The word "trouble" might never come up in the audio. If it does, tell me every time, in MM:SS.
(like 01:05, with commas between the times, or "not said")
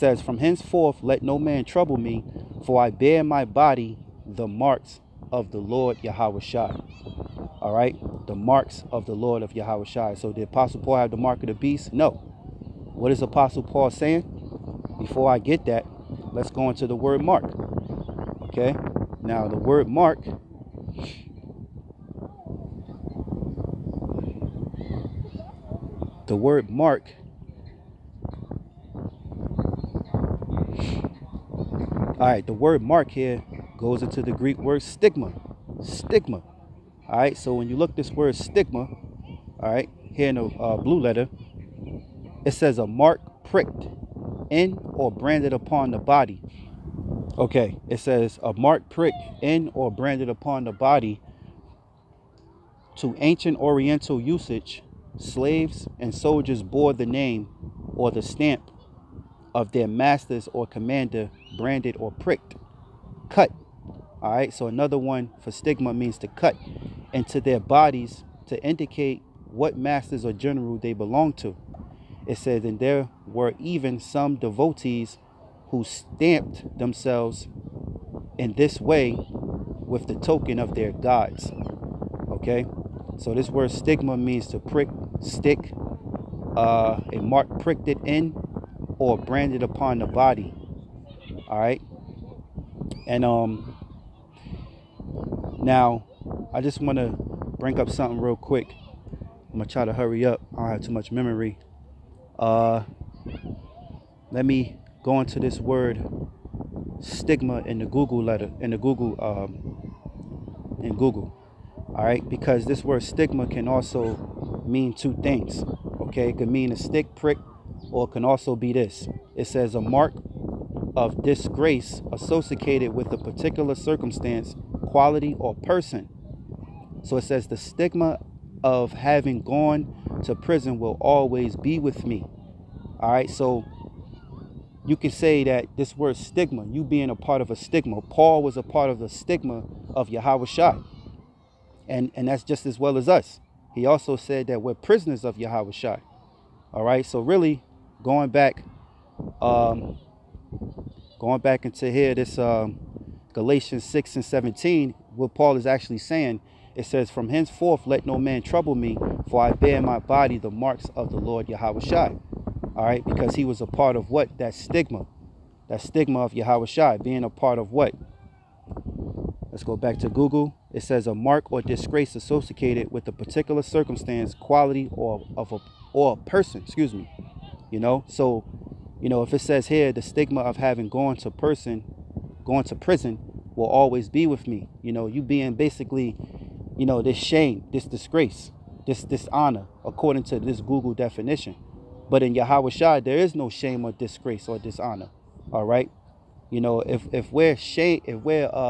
00:01, 02:38.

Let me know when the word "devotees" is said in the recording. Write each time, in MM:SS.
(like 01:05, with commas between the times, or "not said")
01:14.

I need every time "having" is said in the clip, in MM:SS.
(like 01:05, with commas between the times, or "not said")
02:08, 03:00.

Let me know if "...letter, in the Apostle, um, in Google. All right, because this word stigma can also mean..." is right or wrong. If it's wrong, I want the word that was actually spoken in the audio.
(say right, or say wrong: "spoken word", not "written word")
wrong: "Google", not "Apostle".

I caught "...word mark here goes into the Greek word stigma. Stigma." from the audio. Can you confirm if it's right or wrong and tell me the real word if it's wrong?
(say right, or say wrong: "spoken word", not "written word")
right.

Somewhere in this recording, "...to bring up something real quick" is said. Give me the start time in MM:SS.
01:36.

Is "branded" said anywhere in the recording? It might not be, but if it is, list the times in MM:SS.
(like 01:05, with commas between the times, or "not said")
00:45, 00:49, 01:01, 01:29.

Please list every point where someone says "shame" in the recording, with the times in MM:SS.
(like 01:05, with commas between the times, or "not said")
03:07, 03:13, 03:17.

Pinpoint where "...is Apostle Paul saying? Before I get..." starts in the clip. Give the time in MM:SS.
00:13.